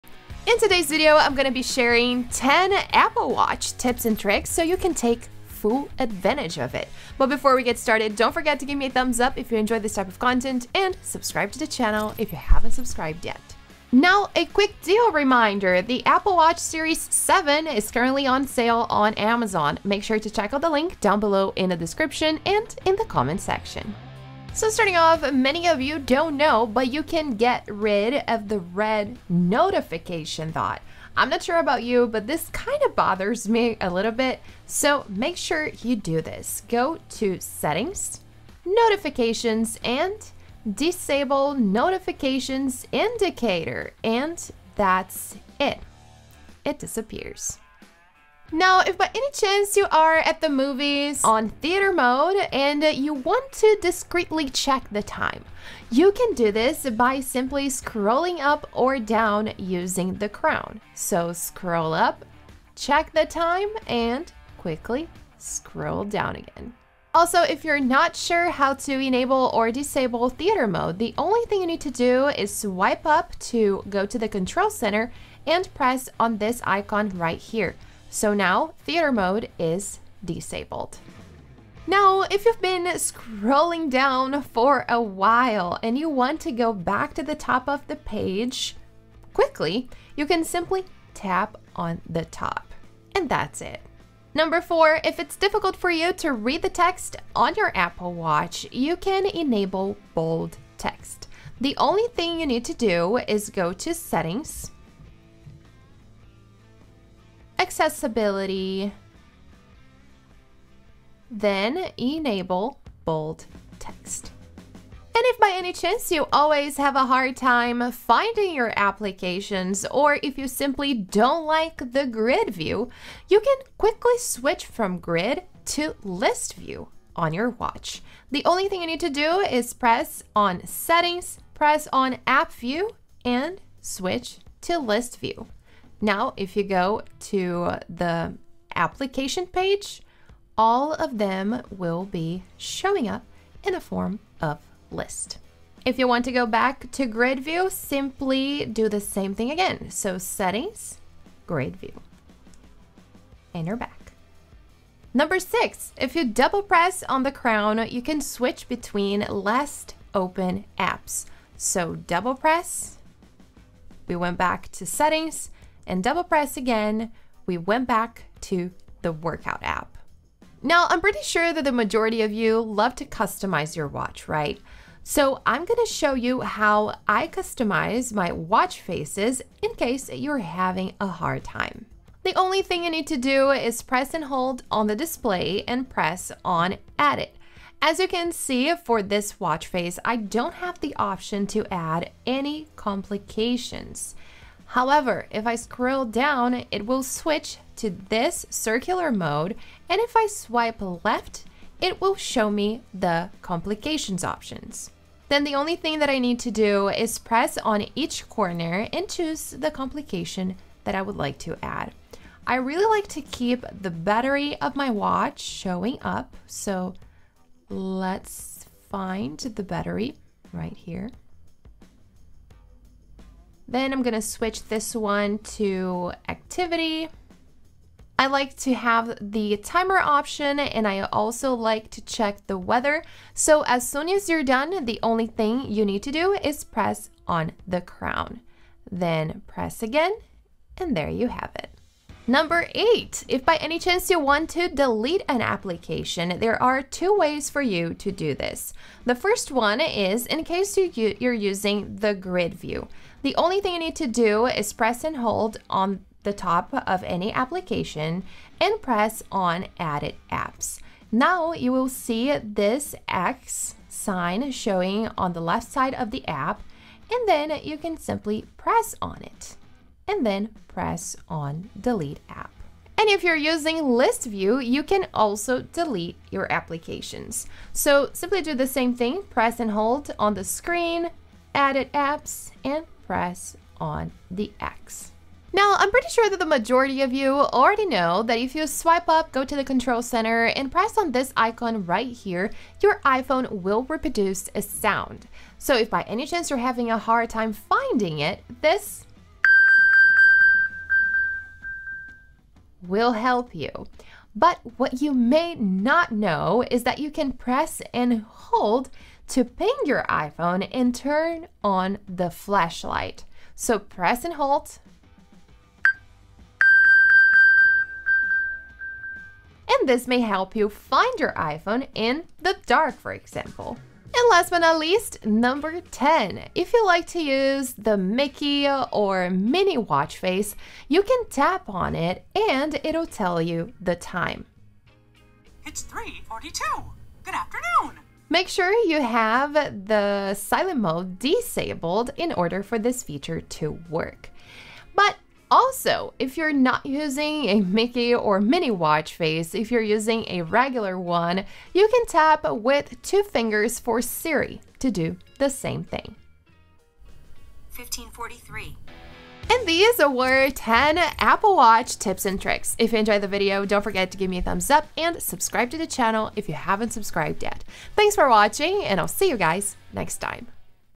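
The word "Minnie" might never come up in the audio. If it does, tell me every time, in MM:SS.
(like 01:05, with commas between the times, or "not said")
05:29, 05:48.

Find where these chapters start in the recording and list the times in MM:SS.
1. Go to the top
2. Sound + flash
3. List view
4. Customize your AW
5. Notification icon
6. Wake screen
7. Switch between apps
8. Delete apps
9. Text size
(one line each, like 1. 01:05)
1. 01:21
2. 04:45
3. 01:55
4. 02:50
5. 00:24
6. 00:48
7. 02:34
8. 04:01
9. 01:34.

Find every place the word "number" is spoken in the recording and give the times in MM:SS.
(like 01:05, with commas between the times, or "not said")
01:34, 02:35, 04:02, 05:25.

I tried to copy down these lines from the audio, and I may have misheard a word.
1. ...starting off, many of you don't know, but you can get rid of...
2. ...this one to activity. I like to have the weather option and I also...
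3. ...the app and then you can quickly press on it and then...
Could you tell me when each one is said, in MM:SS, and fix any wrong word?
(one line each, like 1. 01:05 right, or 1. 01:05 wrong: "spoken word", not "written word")
1. 00:24 right
2. 03:44 wrong: "timer", not "weather"
3. 04:26 wrong: "simply", not "quickly".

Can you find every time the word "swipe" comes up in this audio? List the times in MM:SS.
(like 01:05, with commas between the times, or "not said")
01:12, 03:20, 04:48.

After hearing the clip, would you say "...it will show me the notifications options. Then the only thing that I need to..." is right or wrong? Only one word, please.
wrong.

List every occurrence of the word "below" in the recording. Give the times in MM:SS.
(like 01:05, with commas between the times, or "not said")
00:21.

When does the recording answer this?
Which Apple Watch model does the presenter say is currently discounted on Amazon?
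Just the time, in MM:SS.
00:16.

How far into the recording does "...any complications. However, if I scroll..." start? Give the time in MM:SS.
03:12.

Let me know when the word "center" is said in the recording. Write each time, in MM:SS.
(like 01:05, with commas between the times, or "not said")
01:14, 04:50.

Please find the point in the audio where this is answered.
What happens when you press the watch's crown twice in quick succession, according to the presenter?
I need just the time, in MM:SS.
02:38.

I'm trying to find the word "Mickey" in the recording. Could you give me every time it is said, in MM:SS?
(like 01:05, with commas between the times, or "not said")
05:27, 05:47.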